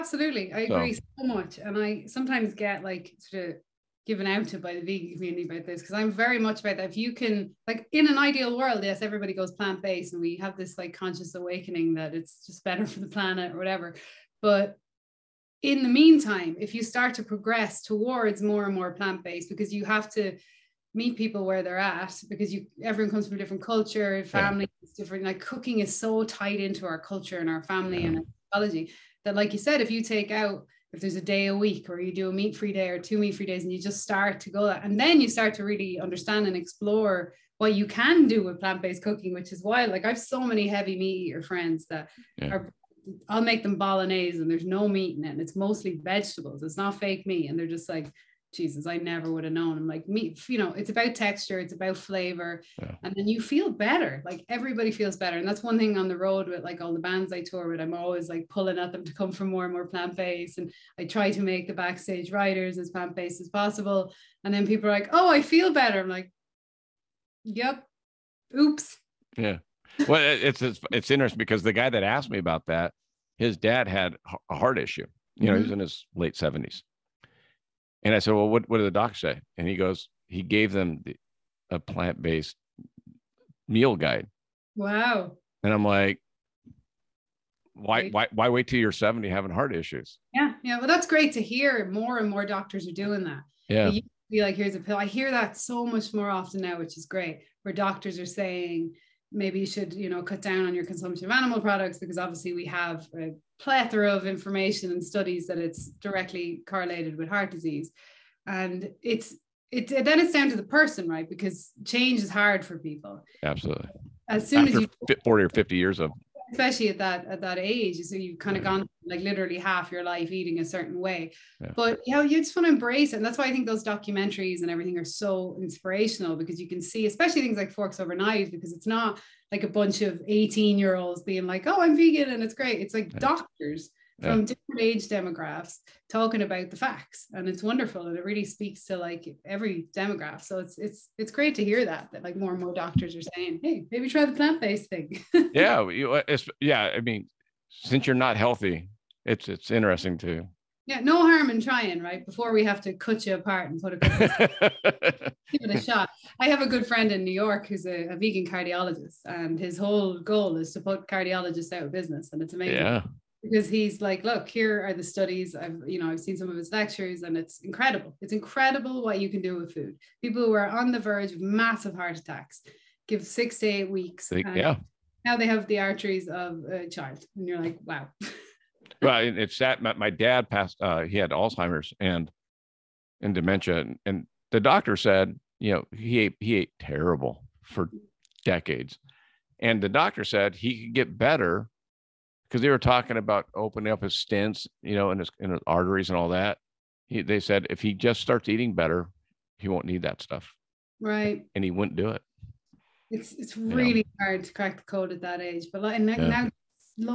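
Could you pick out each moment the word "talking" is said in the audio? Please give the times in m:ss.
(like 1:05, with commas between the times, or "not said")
2:16, 3:12.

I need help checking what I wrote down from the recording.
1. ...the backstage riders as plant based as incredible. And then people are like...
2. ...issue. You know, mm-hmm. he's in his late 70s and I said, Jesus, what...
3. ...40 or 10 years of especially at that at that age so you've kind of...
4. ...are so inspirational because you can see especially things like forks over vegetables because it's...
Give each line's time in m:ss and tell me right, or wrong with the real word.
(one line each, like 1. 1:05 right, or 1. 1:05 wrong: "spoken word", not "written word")
1. 1:01 wrong: "possible", not "incredible"
2. 1:14 wrong: "Well", not "Jesus"
3. 1:55 wrong: "50", not "10"
4. 2:04 wrong: "knives", not "vegetables".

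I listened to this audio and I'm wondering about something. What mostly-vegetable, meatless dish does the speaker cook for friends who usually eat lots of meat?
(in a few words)
Bolognese.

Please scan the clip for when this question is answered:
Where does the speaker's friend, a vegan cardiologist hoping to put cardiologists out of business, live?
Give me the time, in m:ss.
2:37.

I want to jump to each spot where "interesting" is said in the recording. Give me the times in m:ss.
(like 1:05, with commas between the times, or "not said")
1:11, 2:29.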